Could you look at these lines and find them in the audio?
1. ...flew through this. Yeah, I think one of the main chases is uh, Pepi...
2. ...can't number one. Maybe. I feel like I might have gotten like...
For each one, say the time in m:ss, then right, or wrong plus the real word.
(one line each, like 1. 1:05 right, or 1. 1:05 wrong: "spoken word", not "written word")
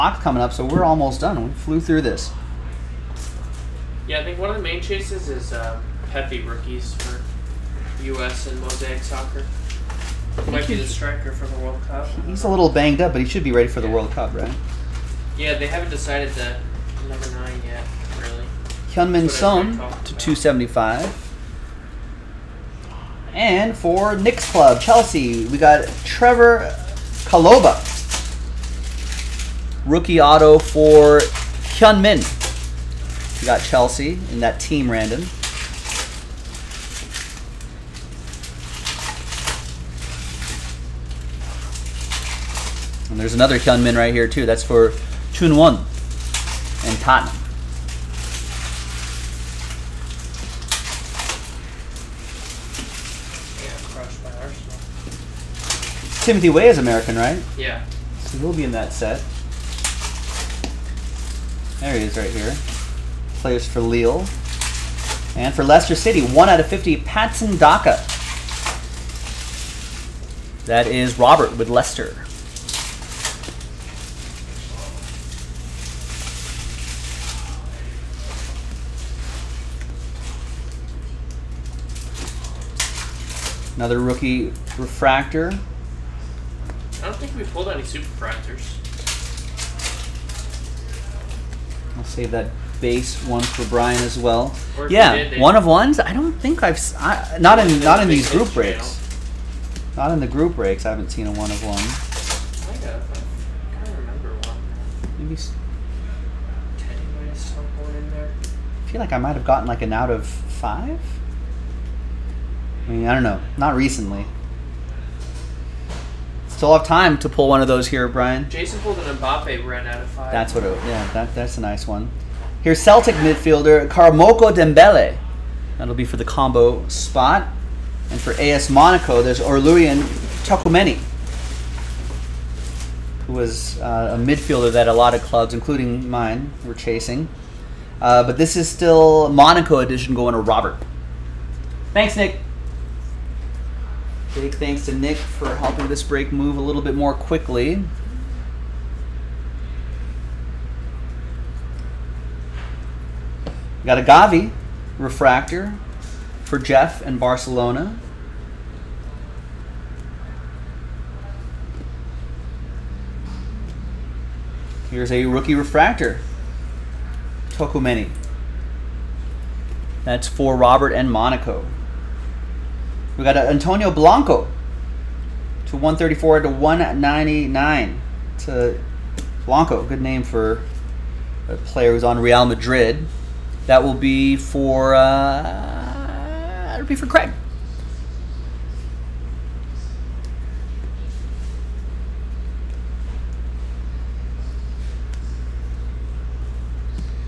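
1. 0:01 right
2. 1:43 wrong: "remember", not "number".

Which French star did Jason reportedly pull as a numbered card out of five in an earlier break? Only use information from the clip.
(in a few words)
Mbappe.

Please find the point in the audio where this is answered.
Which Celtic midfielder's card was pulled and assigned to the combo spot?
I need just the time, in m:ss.
2:03.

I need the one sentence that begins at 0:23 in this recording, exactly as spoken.
And for Nick's Club, Chelsea, we got Trevoh Chalobah.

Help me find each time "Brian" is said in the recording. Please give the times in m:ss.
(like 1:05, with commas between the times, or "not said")
1:33, 1:58.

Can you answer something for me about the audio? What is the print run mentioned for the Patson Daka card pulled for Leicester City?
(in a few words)
1 out of 50.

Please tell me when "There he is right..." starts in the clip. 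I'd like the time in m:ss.
1:01.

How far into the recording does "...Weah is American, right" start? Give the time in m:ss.
0:56.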